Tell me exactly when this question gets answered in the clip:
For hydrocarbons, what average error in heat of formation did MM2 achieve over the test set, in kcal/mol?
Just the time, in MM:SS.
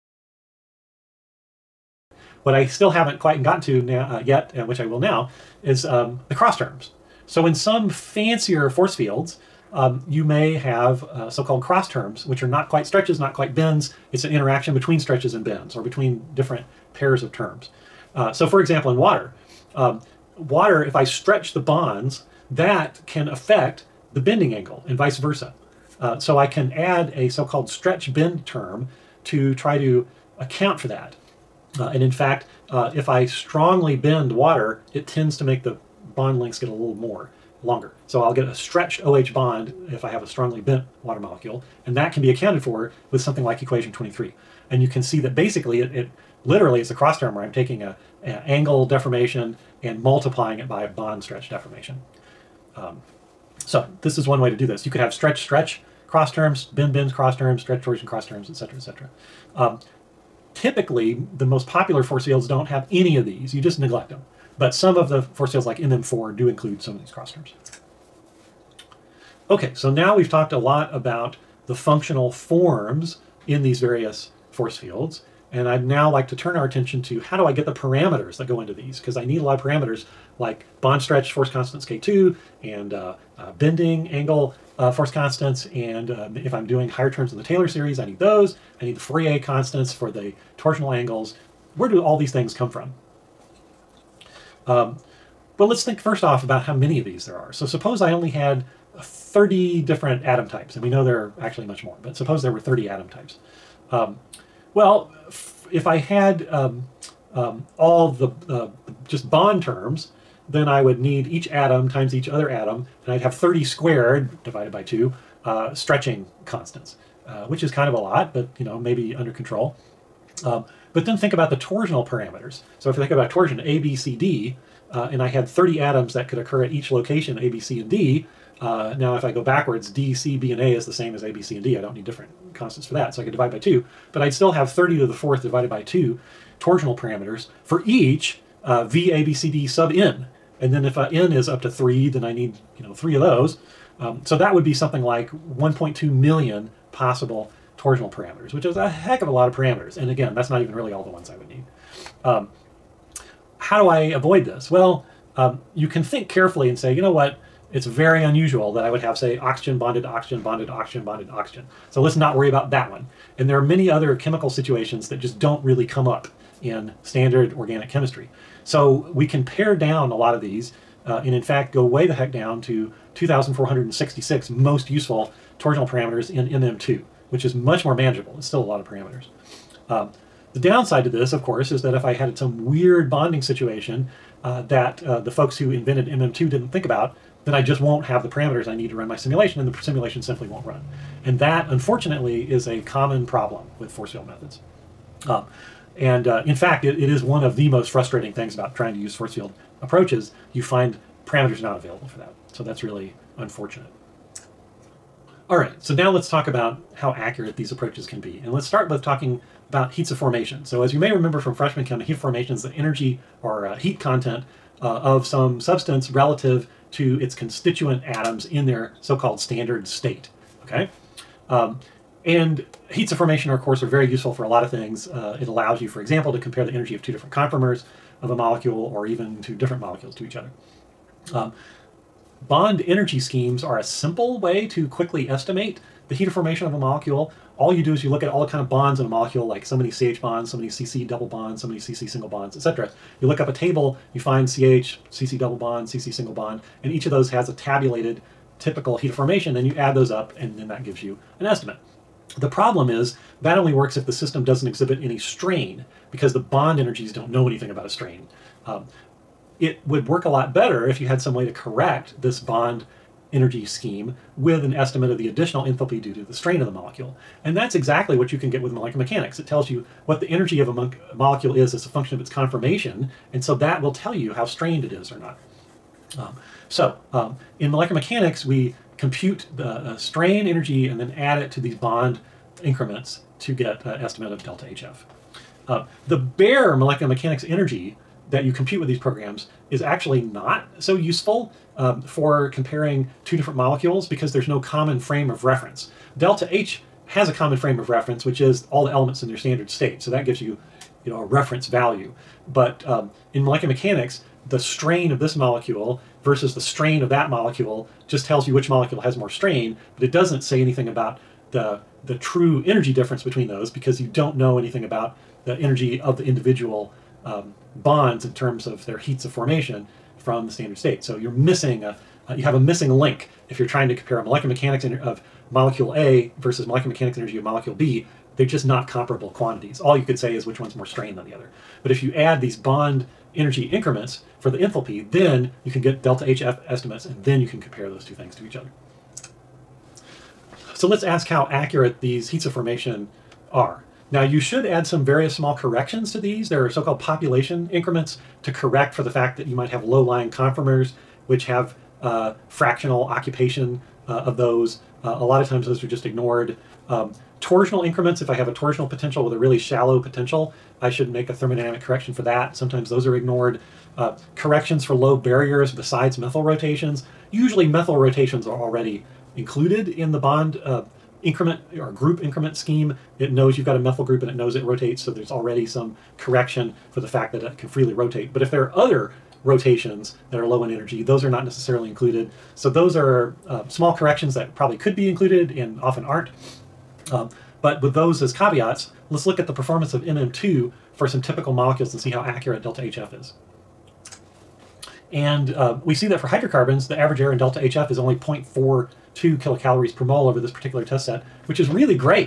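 06:38.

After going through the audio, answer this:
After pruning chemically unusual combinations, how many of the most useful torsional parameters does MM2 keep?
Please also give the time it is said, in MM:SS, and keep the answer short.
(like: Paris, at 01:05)
2,466, at 02:53.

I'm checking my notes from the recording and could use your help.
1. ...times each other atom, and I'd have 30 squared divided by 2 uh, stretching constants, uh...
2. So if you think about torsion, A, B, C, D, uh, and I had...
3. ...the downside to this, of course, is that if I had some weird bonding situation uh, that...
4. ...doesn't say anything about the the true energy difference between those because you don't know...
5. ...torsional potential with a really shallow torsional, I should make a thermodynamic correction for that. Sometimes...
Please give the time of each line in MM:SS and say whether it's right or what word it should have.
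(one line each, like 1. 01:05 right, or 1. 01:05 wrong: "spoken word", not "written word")
1. 01:51 right
2. 02:02 right
3. 03:00 right
4. 05:10 right
5. 05:58 wrong: "potential", not "torsional".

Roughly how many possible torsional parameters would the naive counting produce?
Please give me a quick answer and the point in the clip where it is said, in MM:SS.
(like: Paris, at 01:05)
1.2 million, at 02:25.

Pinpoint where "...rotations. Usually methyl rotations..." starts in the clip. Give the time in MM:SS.
06:06.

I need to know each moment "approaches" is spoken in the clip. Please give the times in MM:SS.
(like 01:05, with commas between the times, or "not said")
03:19, 03:27.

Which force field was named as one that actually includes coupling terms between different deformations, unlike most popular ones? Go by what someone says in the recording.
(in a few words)
MM4.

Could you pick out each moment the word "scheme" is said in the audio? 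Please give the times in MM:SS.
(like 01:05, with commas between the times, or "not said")
03:53, 04:23, 06:12.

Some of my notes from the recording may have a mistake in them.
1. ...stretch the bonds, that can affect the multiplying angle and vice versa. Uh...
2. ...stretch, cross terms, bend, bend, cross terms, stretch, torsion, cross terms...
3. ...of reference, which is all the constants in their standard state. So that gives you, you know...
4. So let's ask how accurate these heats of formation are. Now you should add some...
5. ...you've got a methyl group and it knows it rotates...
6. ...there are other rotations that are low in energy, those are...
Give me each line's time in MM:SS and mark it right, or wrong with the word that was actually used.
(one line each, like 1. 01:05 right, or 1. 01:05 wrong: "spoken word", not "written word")
1. 00:21 wrong: "bending", not "multiplying"
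2. 00:55 right
3. 04:57 wrong: "elements", not "constants"
4. 05:40 right
5. 06:13 right
6. 06:18 right.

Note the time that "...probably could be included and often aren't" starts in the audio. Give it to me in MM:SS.
06:24.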